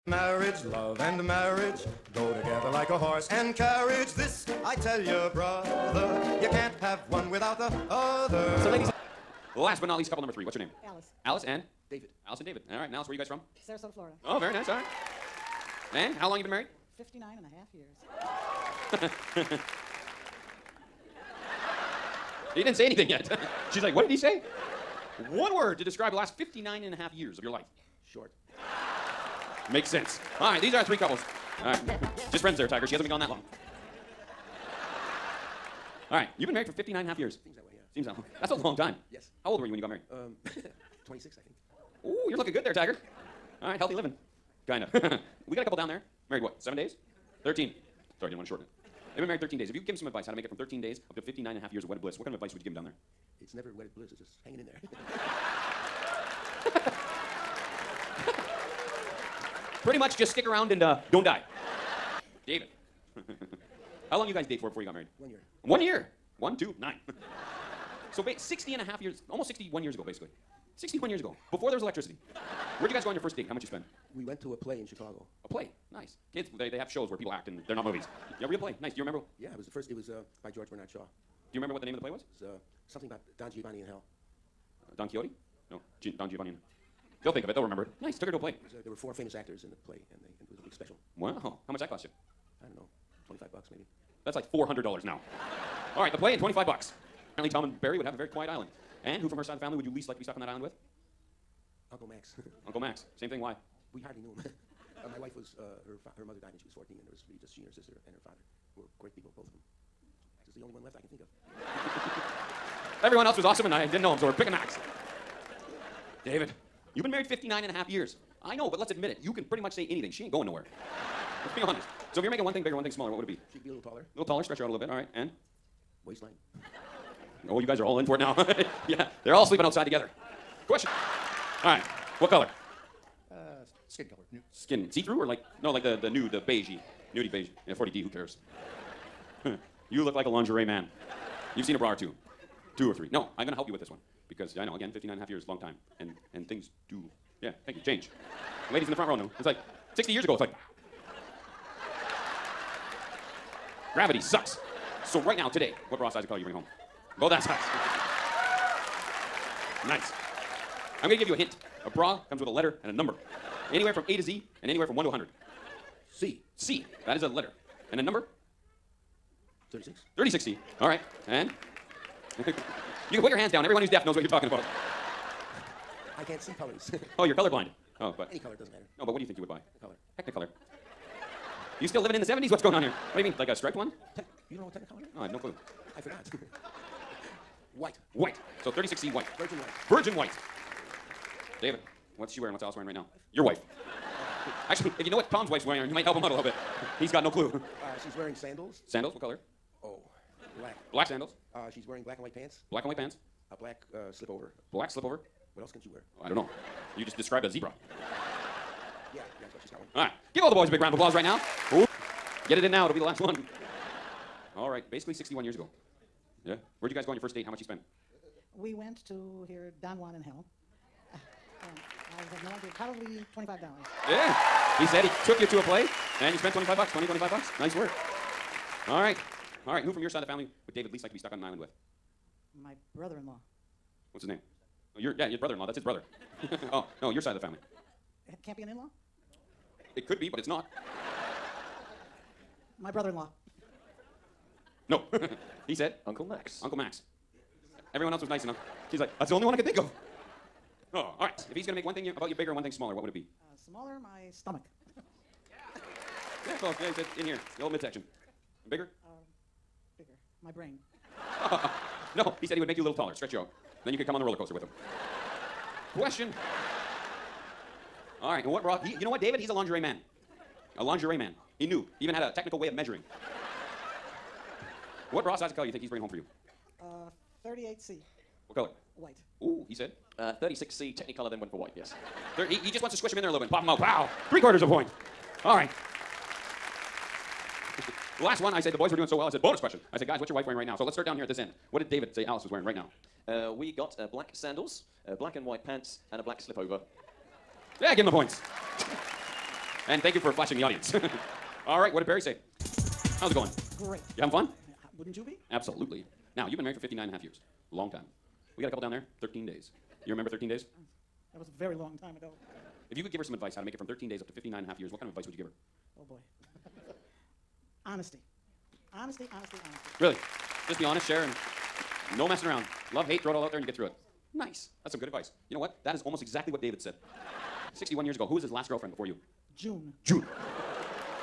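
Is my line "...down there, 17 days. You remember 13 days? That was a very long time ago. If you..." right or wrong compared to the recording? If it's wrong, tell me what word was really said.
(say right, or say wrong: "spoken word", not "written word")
wrong: "13", not "17".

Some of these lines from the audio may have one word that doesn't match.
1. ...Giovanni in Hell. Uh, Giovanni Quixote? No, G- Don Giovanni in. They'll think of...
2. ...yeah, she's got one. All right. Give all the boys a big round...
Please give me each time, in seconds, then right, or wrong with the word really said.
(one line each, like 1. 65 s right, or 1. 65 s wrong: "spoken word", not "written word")
1. 83 s wrong: "Don", not "Giovanni"
2. 209 s right.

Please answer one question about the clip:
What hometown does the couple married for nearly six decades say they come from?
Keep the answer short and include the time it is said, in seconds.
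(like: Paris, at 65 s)
Sarasota, Florida, at 13 s.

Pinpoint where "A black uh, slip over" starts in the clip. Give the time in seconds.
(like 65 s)
203 s.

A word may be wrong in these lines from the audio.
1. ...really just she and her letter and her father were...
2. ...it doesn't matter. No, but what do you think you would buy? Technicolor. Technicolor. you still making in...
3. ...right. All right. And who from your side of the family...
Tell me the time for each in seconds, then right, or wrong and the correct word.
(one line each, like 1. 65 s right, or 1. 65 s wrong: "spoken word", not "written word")
1. 107 s wrong: "sister", not "letter"
2. 178 s wrong: "living", not "making"
3. 228 s right.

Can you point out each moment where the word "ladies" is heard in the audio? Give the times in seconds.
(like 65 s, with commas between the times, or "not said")
8 s, 148 s.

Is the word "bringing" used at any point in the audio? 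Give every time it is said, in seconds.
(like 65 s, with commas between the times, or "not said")
156 s, 275 s.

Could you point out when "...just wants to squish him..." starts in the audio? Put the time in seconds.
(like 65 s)
282 s.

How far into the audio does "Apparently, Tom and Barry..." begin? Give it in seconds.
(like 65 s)
97 s.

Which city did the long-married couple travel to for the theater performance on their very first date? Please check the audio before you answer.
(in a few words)
Chicago.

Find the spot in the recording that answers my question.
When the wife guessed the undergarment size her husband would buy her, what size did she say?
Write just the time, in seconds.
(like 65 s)
277 s.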